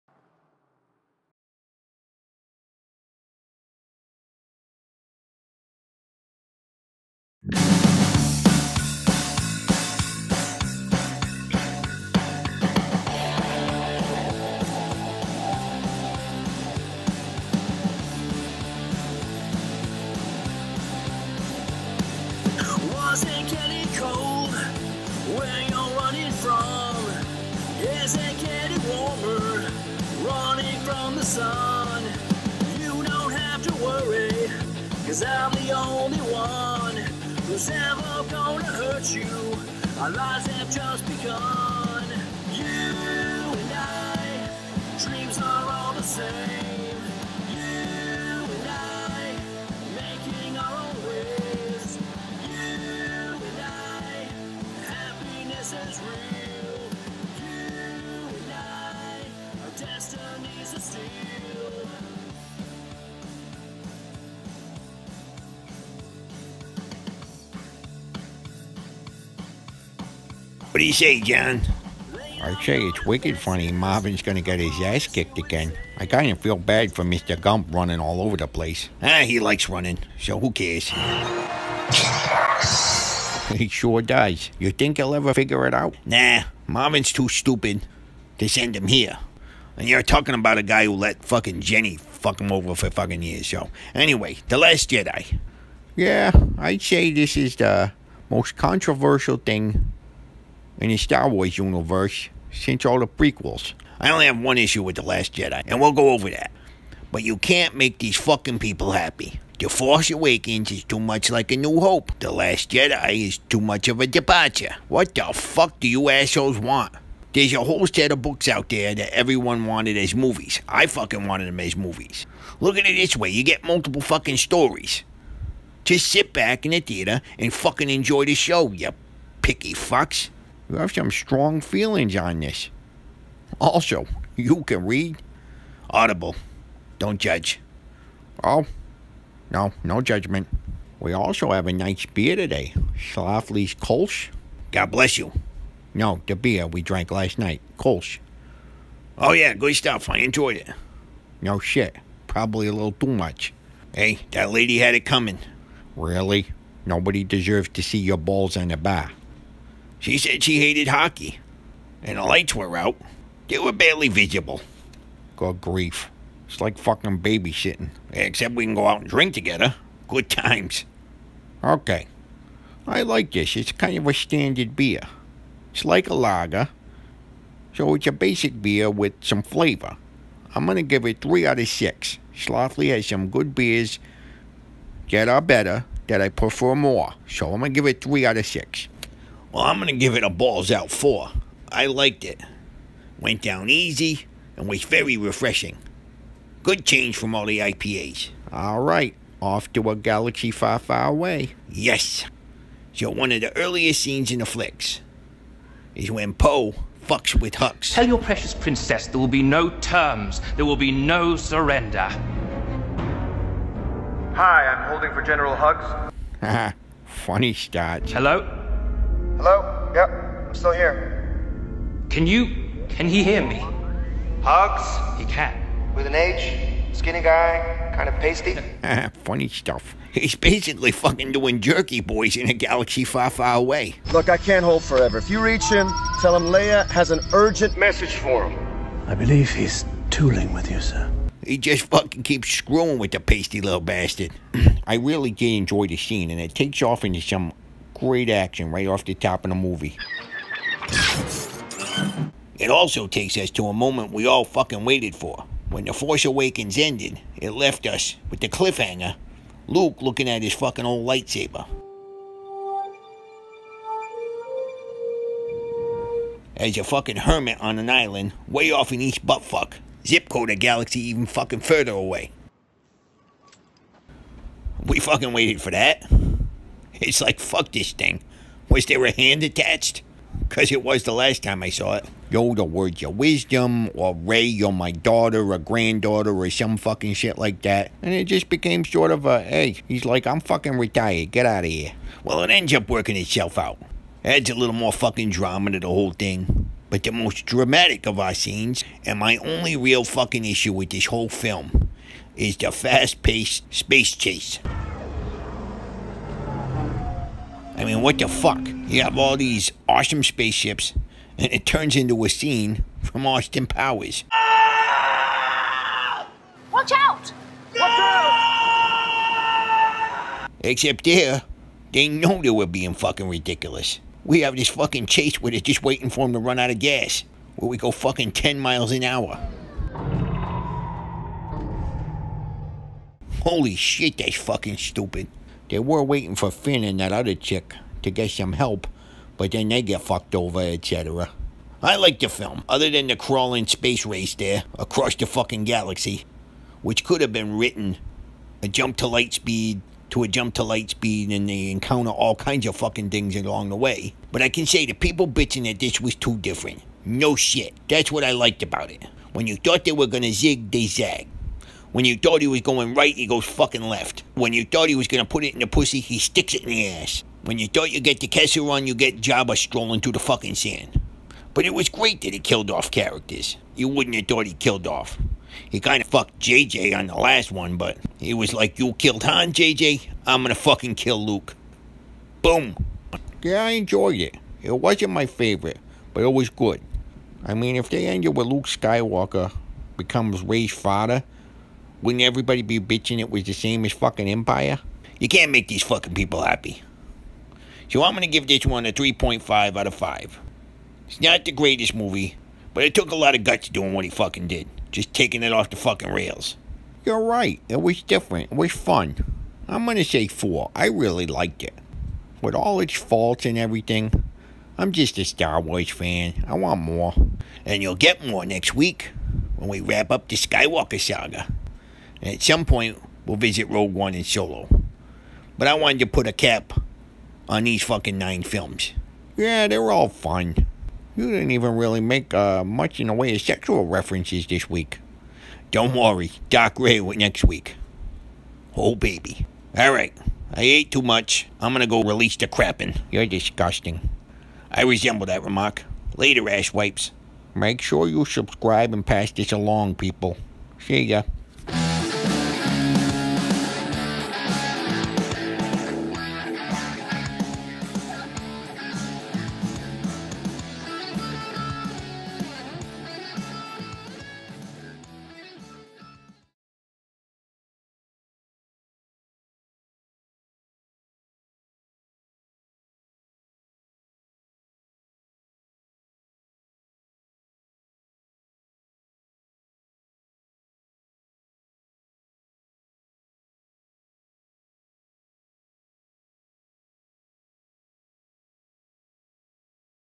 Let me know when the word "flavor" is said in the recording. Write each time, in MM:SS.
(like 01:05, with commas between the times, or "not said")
02:59.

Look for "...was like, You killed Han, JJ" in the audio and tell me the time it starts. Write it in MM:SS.
06:18.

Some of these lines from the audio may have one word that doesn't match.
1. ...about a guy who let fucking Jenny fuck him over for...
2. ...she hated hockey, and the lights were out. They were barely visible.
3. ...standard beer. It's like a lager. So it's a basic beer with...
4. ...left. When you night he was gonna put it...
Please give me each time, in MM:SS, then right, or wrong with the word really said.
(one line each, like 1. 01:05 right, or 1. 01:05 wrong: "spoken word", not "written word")
1. 01:30 right
2. 02:40 right
3. 02:54 right
4. 06:03 wrong: "thought", not "night".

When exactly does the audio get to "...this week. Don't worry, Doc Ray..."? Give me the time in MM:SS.
07:14.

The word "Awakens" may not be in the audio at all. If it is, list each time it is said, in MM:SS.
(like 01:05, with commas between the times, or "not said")
01:50, 04:16.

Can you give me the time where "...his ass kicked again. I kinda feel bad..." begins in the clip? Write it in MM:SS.
01:14.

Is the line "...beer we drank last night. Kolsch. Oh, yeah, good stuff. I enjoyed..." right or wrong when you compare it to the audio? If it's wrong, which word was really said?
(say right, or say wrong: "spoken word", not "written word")
right.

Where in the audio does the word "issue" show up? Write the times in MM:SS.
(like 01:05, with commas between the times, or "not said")
01:44, 05:00.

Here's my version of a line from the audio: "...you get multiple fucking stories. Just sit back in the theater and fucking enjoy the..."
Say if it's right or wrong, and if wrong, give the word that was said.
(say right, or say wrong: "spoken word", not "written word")
right.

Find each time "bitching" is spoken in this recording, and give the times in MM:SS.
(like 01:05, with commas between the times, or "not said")
05:55, 06:32.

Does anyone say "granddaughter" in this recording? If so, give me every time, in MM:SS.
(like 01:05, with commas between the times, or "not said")
04:45.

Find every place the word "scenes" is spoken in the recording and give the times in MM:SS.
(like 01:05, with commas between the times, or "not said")
03:24, 04:05, 04:58, 05:12.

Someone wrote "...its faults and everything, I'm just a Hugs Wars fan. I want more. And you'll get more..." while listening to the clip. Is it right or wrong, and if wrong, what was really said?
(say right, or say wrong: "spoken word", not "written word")
wrong: "Star", not "Hugs".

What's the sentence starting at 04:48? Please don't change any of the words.
And it just became sort of a, hey, he's like, I'm fucking retired, get out of here.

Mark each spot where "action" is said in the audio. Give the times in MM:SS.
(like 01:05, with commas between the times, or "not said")
04:08.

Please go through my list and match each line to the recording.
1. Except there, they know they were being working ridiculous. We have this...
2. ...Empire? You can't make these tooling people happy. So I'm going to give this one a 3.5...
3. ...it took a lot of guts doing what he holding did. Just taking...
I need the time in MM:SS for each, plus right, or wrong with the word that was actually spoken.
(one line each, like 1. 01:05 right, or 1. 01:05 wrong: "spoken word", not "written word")
1. 05:20 wrong: "fucking", not "working"
2. 06:34 wrong: "fucking", not "tooling"
3. 06:42 wrong: "fucking", not "holding".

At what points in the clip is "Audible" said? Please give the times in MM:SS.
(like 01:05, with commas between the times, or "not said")
02:15.